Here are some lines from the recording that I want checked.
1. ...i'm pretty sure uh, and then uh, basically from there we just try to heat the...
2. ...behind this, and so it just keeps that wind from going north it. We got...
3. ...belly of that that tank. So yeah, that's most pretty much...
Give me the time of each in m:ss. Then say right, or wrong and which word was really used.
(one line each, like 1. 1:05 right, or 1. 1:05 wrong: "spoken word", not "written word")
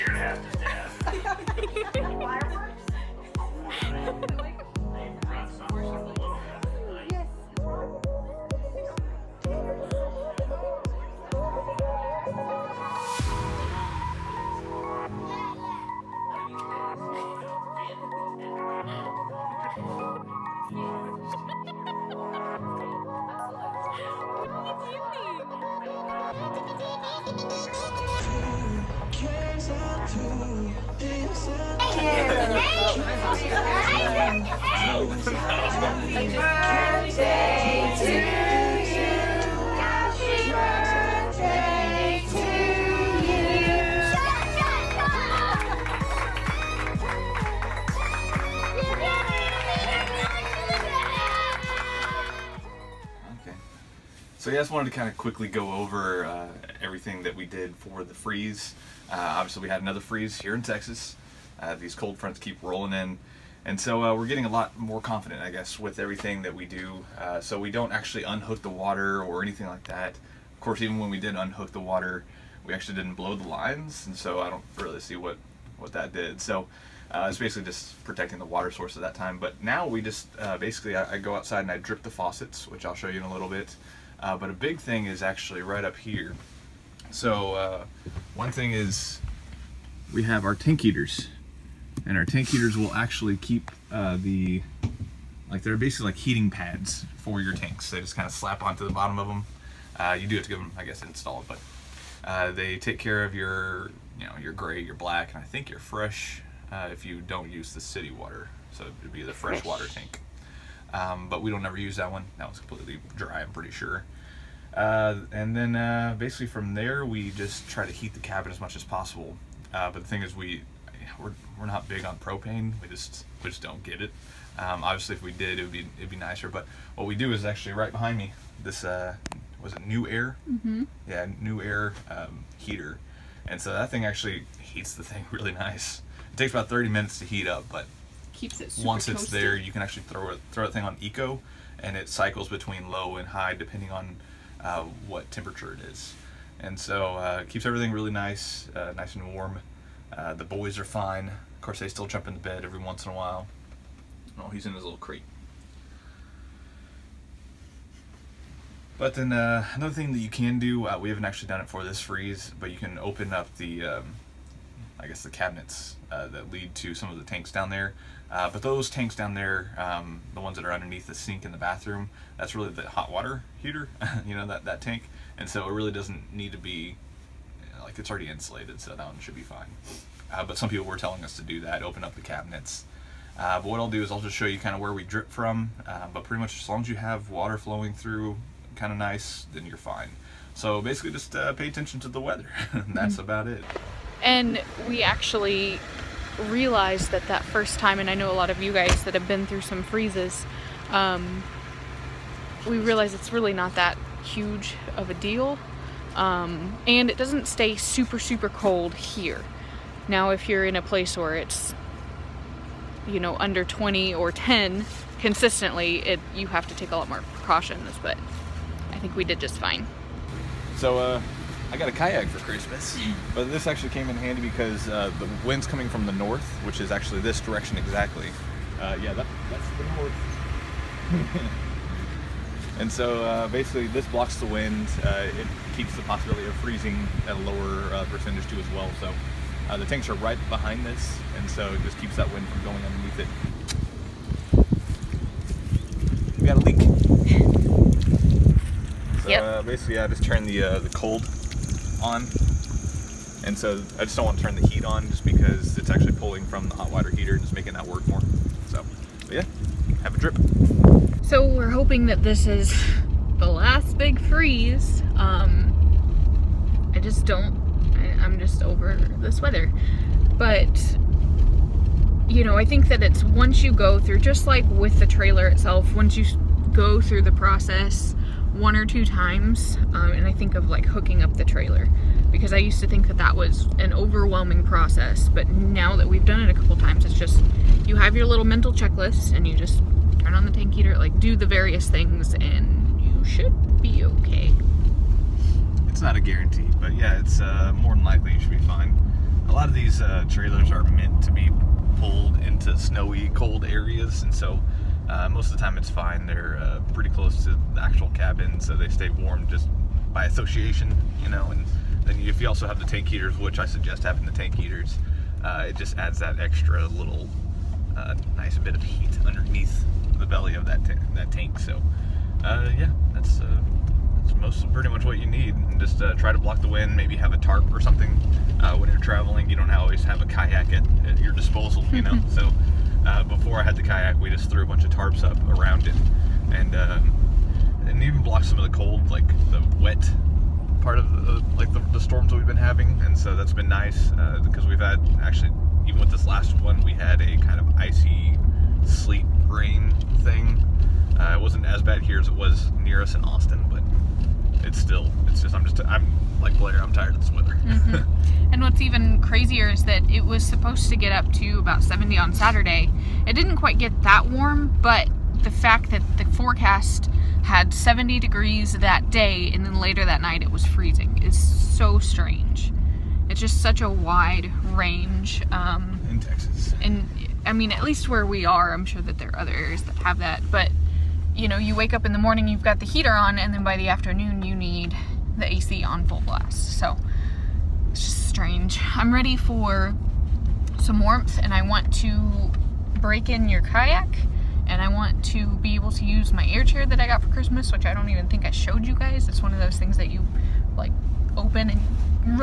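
1. 1:53 right
2. 4:00 wrong: "underneath", not "north"
3. 5:20 right.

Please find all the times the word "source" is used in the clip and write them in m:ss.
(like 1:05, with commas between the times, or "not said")
1:18.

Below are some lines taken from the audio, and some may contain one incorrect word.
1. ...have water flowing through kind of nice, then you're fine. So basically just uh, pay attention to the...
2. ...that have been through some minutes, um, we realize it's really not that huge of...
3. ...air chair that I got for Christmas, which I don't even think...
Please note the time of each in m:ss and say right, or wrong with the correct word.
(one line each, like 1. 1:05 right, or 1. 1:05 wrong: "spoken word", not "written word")
1. 3:06 right
2. 3:19 wrong: "freezes", not "minutes"
3. 6:36 right.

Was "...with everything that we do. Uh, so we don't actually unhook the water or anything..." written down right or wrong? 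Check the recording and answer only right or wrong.
right.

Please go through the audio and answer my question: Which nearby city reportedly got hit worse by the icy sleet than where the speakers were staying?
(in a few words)
Austin.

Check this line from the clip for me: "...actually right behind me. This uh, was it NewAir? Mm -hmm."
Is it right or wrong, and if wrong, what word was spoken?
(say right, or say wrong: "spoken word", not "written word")
right.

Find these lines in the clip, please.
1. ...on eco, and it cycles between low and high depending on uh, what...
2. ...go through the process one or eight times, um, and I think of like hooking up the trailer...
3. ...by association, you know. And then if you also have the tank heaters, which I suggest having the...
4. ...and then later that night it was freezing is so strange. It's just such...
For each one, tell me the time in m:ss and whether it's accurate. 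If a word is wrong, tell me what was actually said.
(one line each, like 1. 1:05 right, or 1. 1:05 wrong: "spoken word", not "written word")
1. 2:20 right
2. 4:36 wrong: "two", not "eight"
3. 5:10 right
4. 6:09 right.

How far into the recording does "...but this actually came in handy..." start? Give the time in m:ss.
3:43.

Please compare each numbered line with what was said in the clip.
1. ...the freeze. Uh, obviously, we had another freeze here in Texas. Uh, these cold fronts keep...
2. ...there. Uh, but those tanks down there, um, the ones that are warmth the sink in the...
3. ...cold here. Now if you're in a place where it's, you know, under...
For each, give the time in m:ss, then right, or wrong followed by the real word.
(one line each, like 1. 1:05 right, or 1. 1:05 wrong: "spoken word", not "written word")
1. 0:58 right
2. 2:47 wrong: "underneath", not "warmth"
3. 3:28 right.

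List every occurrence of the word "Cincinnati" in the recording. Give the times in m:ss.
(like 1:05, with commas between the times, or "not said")
not said.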